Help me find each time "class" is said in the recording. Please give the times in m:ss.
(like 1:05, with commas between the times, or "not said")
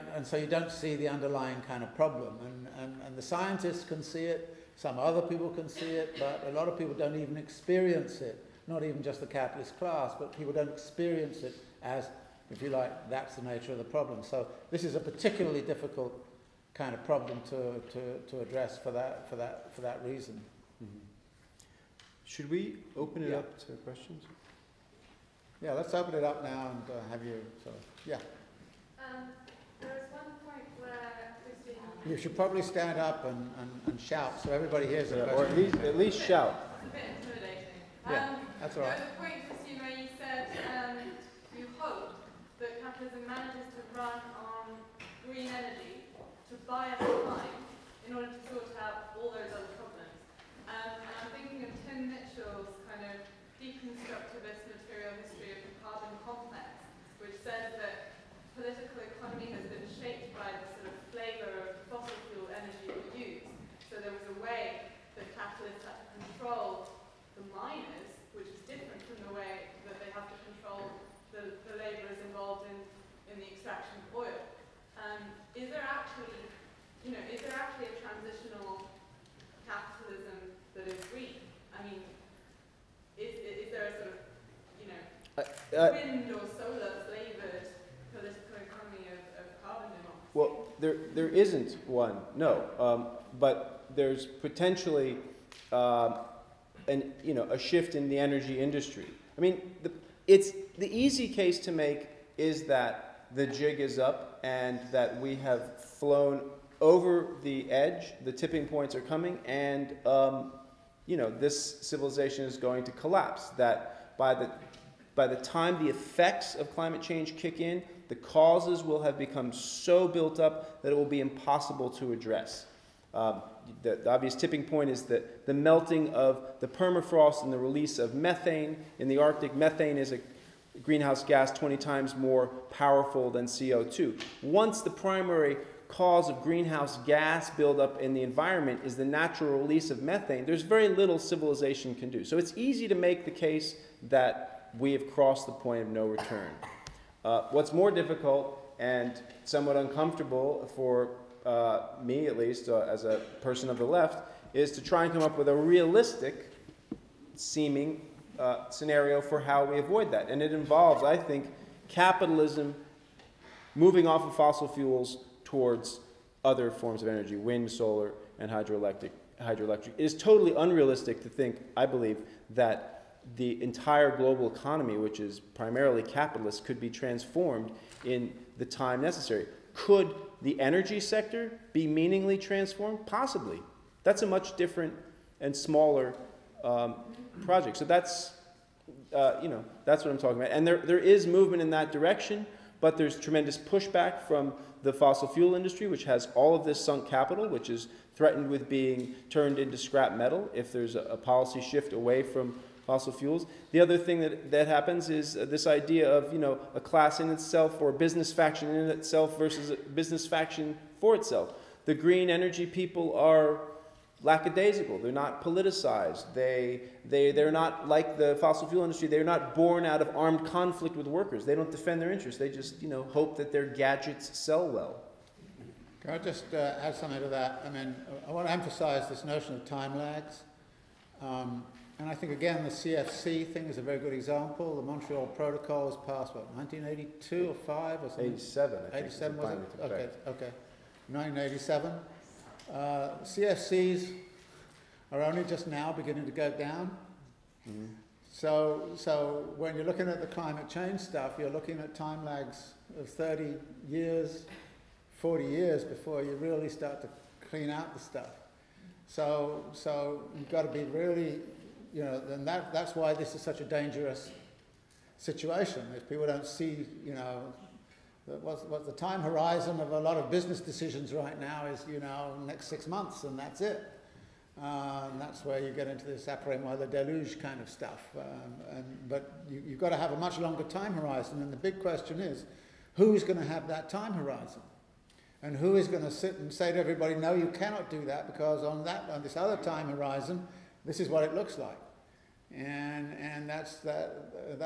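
0:09, 3:26.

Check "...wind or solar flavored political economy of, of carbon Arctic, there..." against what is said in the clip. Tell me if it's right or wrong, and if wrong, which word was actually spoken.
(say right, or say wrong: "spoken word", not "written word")
wrong: "Well", not "Arctic".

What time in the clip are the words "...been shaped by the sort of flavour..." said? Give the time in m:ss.
0:59.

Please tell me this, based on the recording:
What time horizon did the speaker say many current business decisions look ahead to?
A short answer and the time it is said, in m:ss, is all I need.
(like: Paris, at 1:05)
6 months, at 4:32.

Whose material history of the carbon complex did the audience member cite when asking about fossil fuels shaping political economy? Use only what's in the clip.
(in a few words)
Tim Mitchell.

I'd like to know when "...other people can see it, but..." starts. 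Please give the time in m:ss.
0:04.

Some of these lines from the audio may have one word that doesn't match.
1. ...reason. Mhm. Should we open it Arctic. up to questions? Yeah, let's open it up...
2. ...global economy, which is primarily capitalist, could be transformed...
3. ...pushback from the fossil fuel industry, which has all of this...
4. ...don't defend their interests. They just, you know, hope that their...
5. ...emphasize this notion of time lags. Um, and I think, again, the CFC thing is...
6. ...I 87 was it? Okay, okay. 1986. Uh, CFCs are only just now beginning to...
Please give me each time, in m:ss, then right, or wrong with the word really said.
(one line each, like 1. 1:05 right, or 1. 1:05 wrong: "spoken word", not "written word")
1. 0:20 wrong: "Yeah", not "Arctic"
2. 2:54 right
3. 3:13 right
4. 3:41 right
5. 3:48 right
6. 3:58 wrong: "1987", not "1986".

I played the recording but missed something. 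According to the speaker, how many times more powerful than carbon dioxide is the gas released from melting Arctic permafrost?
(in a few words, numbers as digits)
20.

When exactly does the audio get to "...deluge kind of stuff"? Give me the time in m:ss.
4:36.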